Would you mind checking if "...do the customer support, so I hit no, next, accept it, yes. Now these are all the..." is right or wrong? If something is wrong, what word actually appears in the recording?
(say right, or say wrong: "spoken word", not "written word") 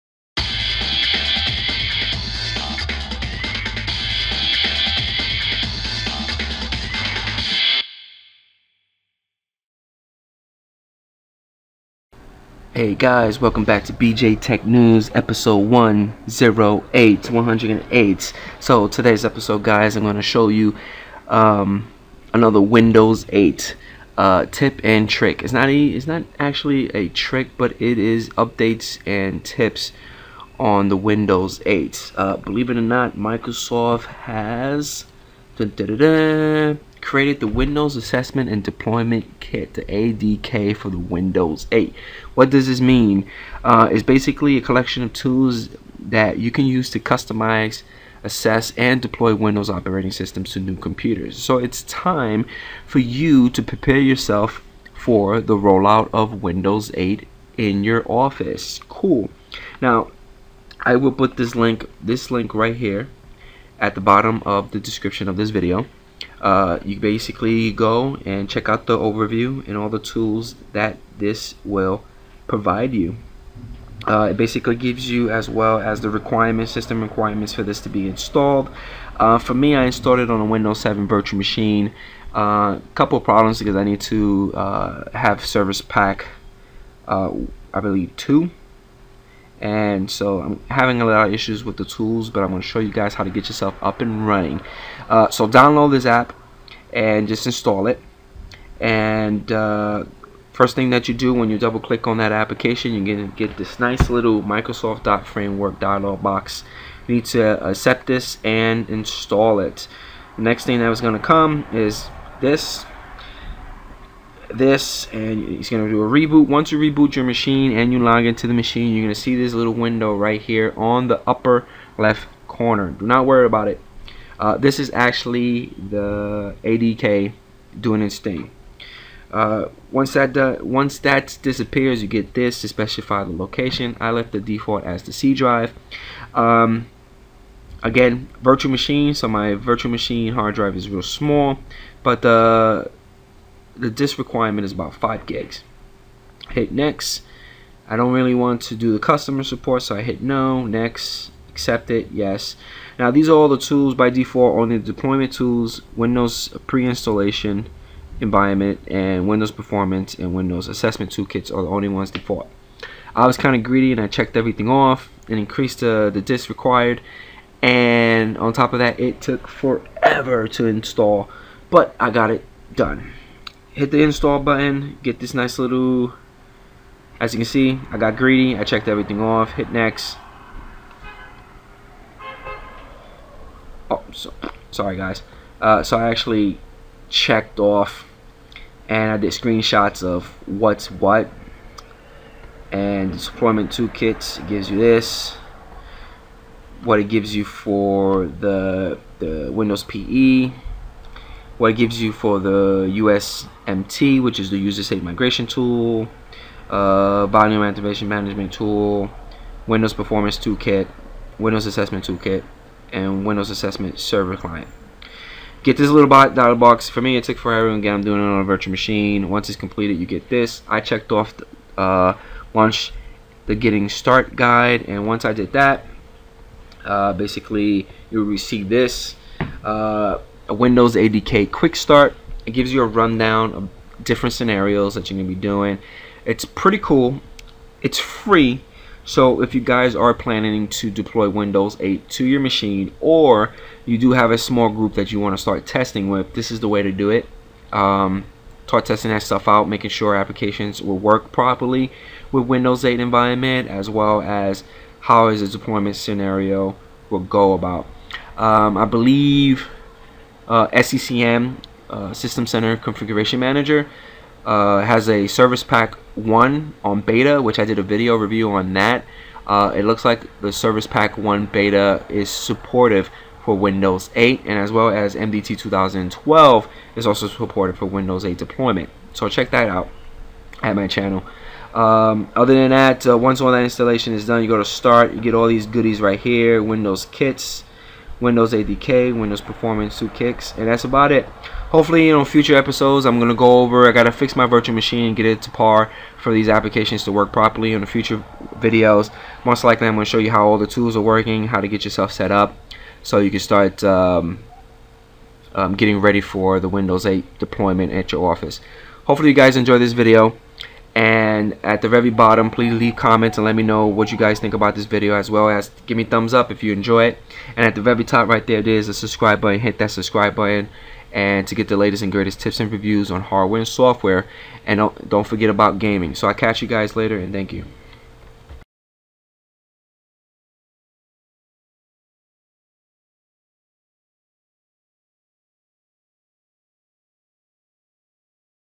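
right.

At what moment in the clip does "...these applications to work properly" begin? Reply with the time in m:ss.
4:56.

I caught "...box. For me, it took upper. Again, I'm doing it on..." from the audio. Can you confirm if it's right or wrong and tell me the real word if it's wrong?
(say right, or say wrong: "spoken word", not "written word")
wrong: "forever", not "upper".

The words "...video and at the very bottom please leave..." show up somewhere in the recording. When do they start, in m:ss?
5:09.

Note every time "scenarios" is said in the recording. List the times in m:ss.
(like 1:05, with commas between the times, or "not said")
3:54, 4:15.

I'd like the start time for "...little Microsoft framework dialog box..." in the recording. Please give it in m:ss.
1:44.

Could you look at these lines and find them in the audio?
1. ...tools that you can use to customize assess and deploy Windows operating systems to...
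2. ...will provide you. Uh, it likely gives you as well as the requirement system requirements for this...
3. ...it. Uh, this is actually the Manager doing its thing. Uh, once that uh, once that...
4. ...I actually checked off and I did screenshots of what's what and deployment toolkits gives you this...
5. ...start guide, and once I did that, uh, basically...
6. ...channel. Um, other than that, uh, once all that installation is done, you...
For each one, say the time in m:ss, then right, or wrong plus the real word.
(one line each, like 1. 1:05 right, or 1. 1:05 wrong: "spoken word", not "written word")
1. 0:45 right
2. 1:11 wrong: "basically", not "likely"
3. 2:03 wrong: "ADK", not "Manager"
4. 3:05 right
5. 3:43 right
6. 4:40 right.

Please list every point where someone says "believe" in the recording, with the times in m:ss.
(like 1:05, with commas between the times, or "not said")
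0:32, 1:27, 4:18.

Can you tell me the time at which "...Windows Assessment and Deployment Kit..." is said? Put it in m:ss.
0:37.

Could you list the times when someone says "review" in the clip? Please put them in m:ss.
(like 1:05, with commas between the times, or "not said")
4:28, 5:22.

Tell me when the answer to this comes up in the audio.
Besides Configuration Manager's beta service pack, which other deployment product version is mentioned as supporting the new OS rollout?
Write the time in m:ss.
4:35.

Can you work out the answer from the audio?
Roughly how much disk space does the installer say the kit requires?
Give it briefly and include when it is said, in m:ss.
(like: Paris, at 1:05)
5 gigs, at 2:24.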